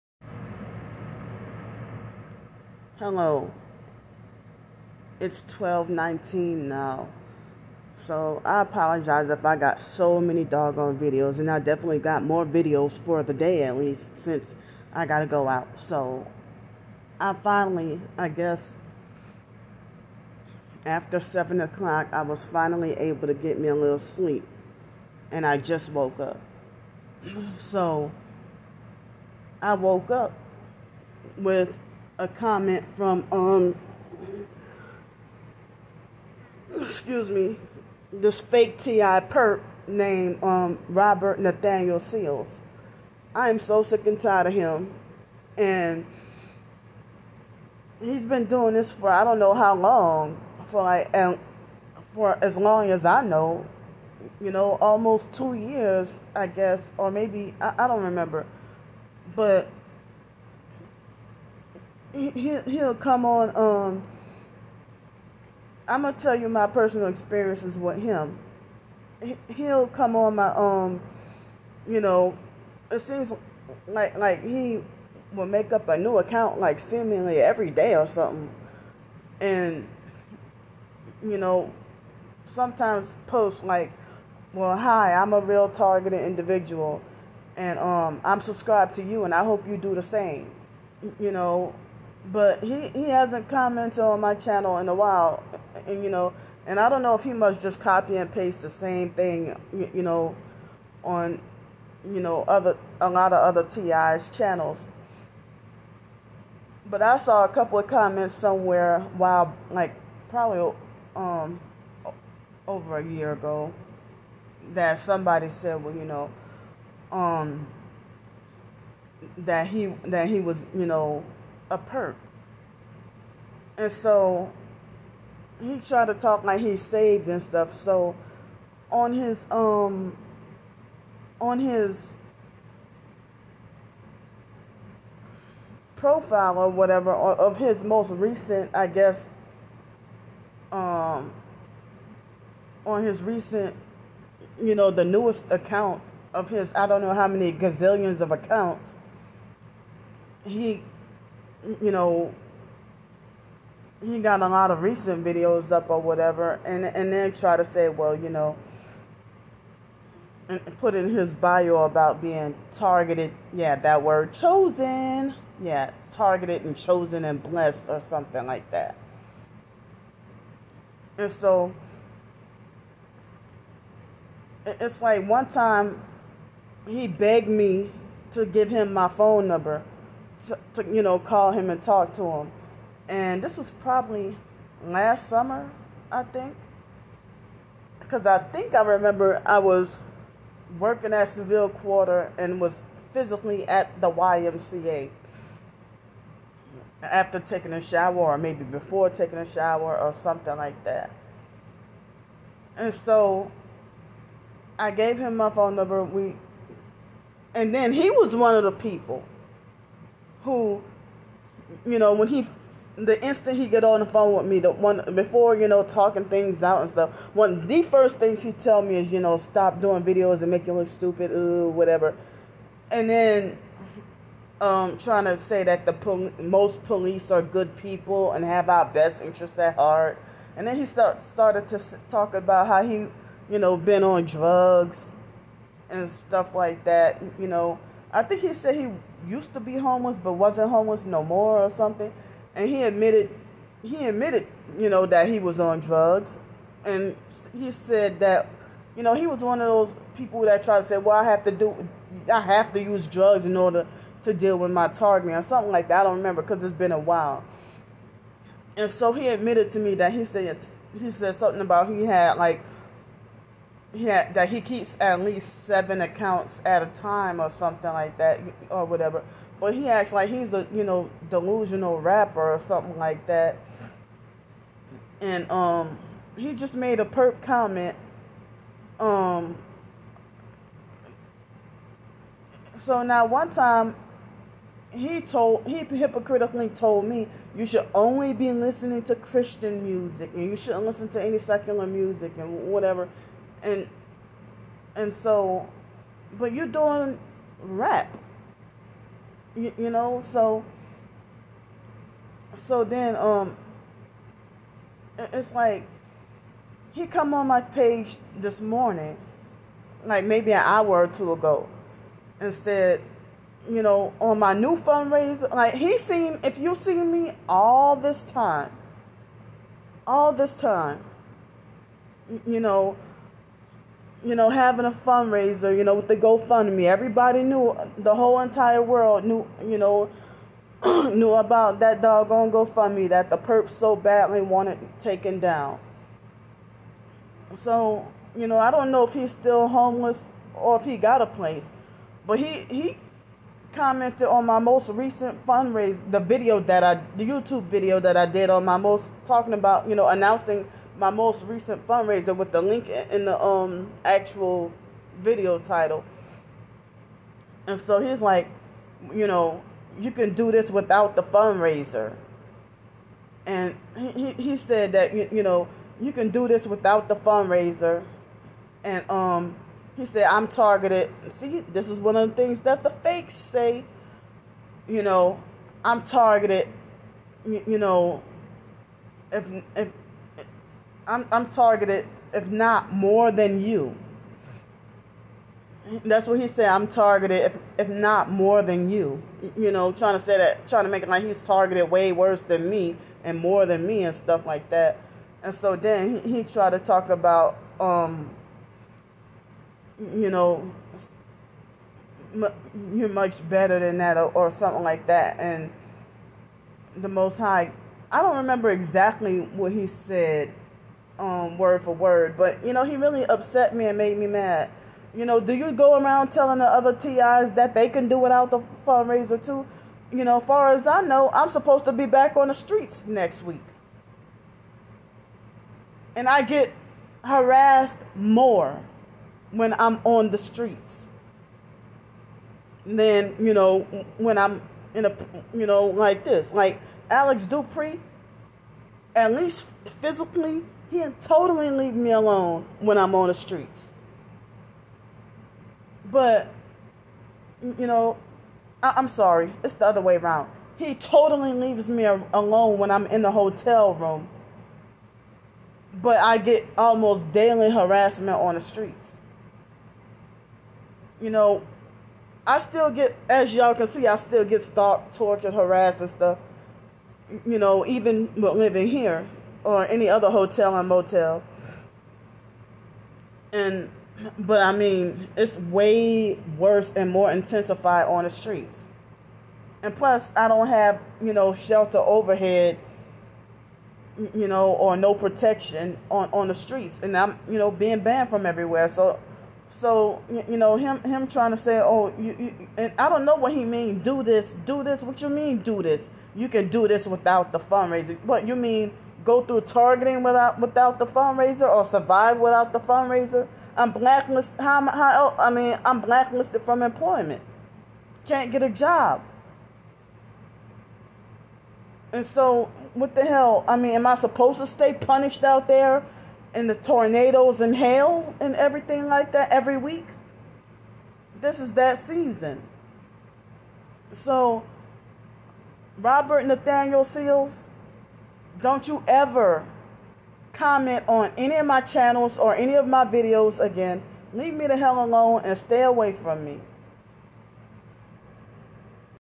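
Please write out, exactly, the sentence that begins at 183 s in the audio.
And this was probably last summer, I think.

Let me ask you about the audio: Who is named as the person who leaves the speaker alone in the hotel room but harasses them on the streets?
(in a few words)
Alex Dupree.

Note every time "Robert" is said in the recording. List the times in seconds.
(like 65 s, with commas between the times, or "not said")
40 s, 525 s.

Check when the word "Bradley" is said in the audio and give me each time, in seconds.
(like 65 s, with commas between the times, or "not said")
not said.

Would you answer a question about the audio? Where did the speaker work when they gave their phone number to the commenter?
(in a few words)
Seville Quarter.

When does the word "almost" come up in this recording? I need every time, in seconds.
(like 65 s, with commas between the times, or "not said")
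54 s, 456 s.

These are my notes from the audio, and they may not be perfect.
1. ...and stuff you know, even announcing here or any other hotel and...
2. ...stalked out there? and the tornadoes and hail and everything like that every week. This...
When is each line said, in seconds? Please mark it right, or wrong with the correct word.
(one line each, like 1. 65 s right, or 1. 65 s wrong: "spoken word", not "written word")
1. 466 s wrong: "living", not "announcing"
2. 514 s wrong: "punished", not "stalked".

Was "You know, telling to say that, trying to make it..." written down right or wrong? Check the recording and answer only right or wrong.
wrong.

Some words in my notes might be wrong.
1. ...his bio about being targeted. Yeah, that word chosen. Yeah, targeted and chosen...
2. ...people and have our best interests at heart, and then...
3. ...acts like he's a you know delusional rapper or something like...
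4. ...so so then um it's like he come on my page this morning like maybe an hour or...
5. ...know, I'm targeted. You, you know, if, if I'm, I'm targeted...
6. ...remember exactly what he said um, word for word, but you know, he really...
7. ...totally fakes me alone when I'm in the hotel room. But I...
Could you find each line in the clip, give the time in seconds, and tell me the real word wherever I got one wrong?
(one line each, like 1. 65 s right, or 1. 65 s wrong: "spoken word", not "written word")
1. 161 s right
2. 227 s right
3. 269 s right
4. 300 s right
5. 375 s right
6. 408 s right
7. 450 s wrong: "leaves", not "fakes".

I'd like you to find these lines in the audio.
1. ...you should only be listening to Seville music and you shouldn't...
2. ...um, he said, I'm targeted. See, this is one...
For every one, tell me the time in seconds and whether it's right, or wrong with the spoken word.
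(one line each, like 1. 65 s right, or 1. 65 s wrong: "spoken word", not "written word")
1. 287 s wrong: "Christian", not "Seville"
2. 369 s right.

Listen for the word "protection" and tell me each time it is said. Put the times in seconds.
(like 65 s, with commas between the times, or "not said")
485 s.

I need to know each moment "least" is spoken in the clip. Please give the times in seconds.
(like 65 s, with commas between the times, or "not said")
13 s, 265 s, 439 s.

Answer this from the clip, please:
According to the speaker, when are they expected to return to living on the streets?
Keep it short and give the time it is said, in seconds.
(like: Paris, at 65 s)
next week, at 423 s.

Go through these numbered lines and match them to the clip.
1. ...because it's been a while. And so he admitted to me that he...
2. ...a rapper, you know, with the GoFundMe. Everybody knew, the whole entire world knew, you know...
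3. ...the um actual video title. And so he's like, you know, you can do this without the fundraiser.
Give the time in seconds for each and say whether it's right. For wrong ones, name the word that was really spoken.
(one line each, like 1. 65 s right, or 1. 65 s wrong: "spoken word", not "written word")
1. 256 s right
2. 324 s wrong: "fundraiser", not "rapper"
3. 353 s right.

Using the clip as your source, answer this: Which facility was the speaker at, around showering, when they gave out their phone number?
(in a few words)
YMCA.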